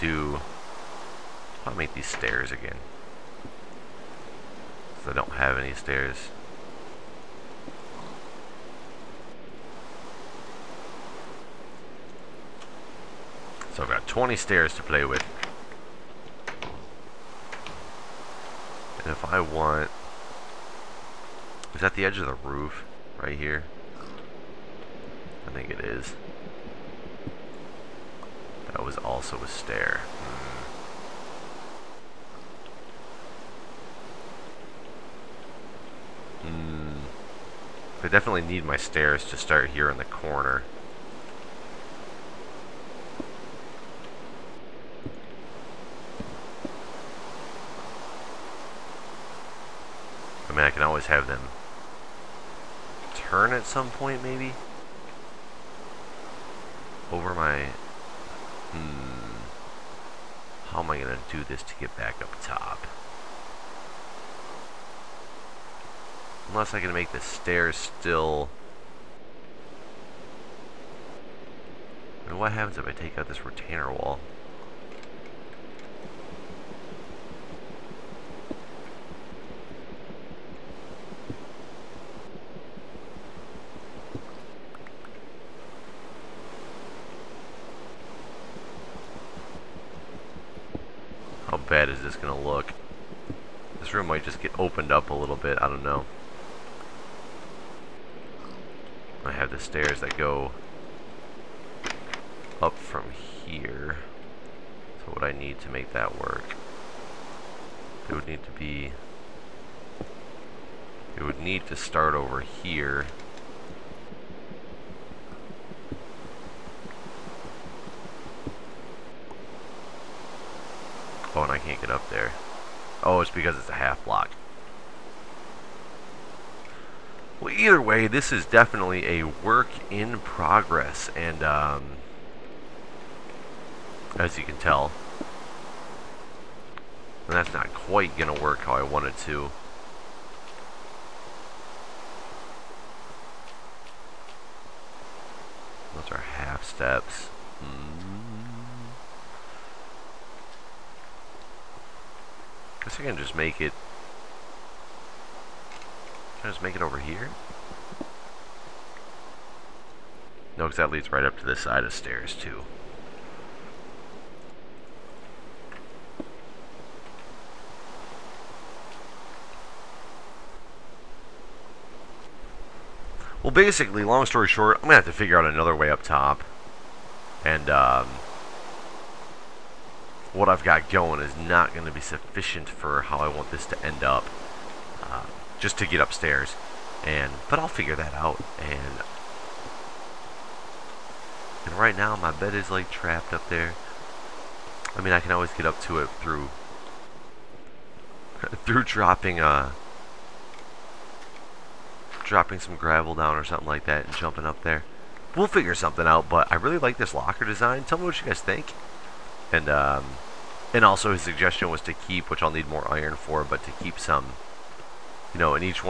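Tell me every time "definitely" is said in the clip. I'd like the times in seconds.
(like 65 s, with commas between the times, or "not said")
38 s, 128 s.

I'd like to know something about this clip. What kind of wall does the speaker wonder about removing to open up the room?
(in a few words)
Retainer wall.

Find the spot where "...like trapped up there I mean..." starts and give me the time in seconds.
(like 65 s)
192 s.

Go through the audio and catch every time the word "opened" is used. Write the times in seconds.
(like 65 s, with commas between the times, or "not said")
94 s.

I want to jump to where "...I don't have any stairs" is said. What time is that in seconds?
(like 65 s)
5 s.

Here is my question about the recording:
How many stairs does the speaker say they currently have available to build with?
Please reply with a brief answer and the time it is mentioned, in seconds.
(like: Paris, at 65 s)
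20, at 14 s.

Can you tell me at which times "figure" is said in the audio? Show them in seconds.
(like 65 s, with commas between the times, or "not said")
175 s, 187 s, 205 s.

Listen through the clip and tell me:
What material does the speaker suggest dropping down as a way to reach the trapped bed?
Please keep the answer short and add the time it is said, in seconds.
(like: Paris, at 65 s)
Gravel, at 202 s.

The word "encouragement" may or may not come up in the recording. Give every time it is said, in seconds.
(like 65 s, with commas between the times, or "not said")
not said.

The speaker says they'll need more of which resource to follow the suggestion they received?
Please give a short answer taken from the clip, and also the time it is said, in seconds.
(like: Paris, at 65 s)
Iron, at 212 s.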